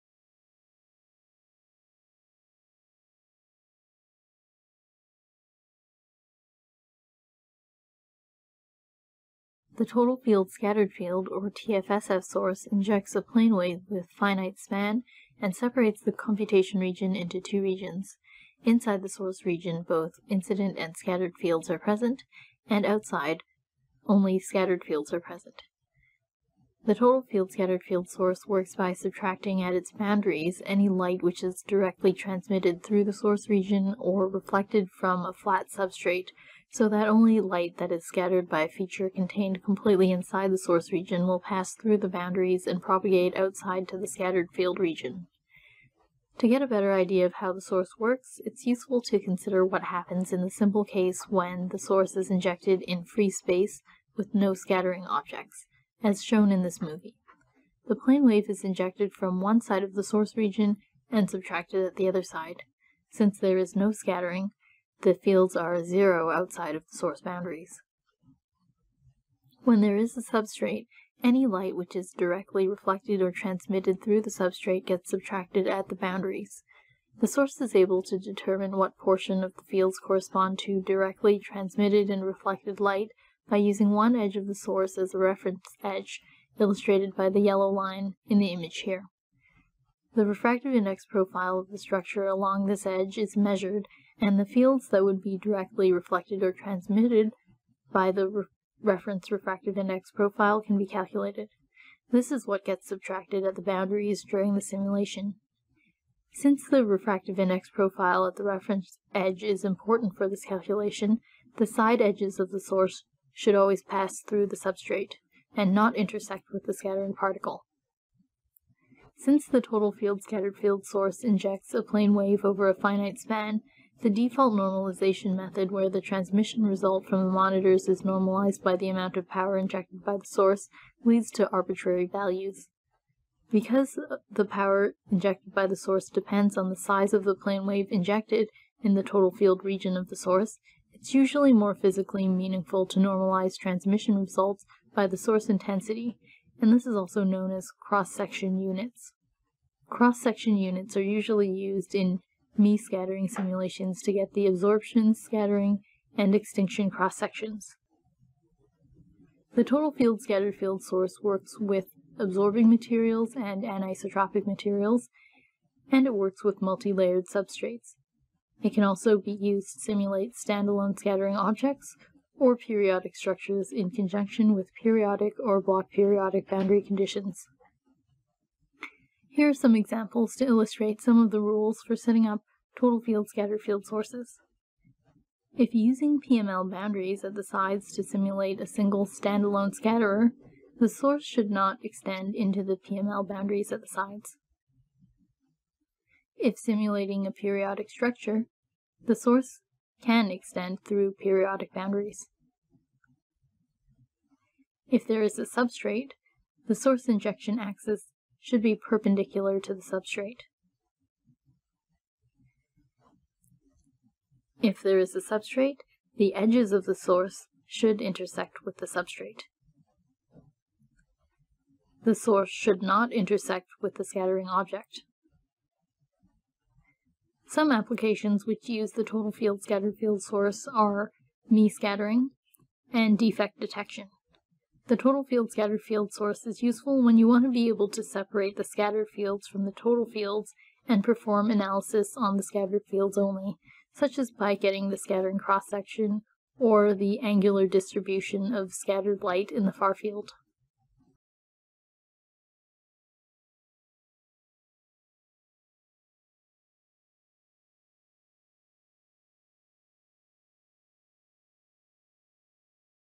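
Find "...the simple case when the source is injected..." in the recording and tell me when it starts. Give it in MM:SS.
00:50.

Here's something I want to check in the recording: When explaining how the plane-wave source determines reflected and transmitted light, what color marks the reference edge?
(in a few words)
Yellow.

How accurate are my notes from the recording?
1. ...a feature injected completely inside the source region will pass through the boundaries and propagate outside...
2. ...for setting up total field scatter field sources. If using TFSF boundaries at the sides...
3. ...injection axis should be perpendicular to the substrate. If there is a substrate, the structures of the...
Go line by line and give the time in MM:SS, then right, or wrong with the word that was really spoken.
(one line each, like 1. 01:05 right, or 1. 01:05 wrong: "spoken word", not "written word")
1. 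00:38 wrong: "contained", not "injected"
2. 03:01 wrong: "PML", not "TFSF"
3. 03:27 wrong: "edges", not "structures".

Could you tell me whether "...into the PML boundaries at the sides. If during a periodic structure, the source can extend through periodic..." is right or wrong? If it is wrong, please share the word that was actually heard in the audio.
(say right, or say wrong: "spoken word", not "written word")
wrong: "simulating", not "during".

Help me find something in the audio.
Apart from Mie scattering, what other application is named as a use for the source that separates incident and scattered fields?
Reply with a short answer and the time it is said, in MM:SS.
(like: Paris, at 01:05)
Defect detection, at 03:53.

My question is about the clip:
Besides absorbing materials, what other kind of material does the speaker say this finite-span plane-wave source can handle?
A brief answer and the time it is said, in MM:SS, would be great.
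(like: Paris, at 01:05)
Anisotropic materials, at 02:43.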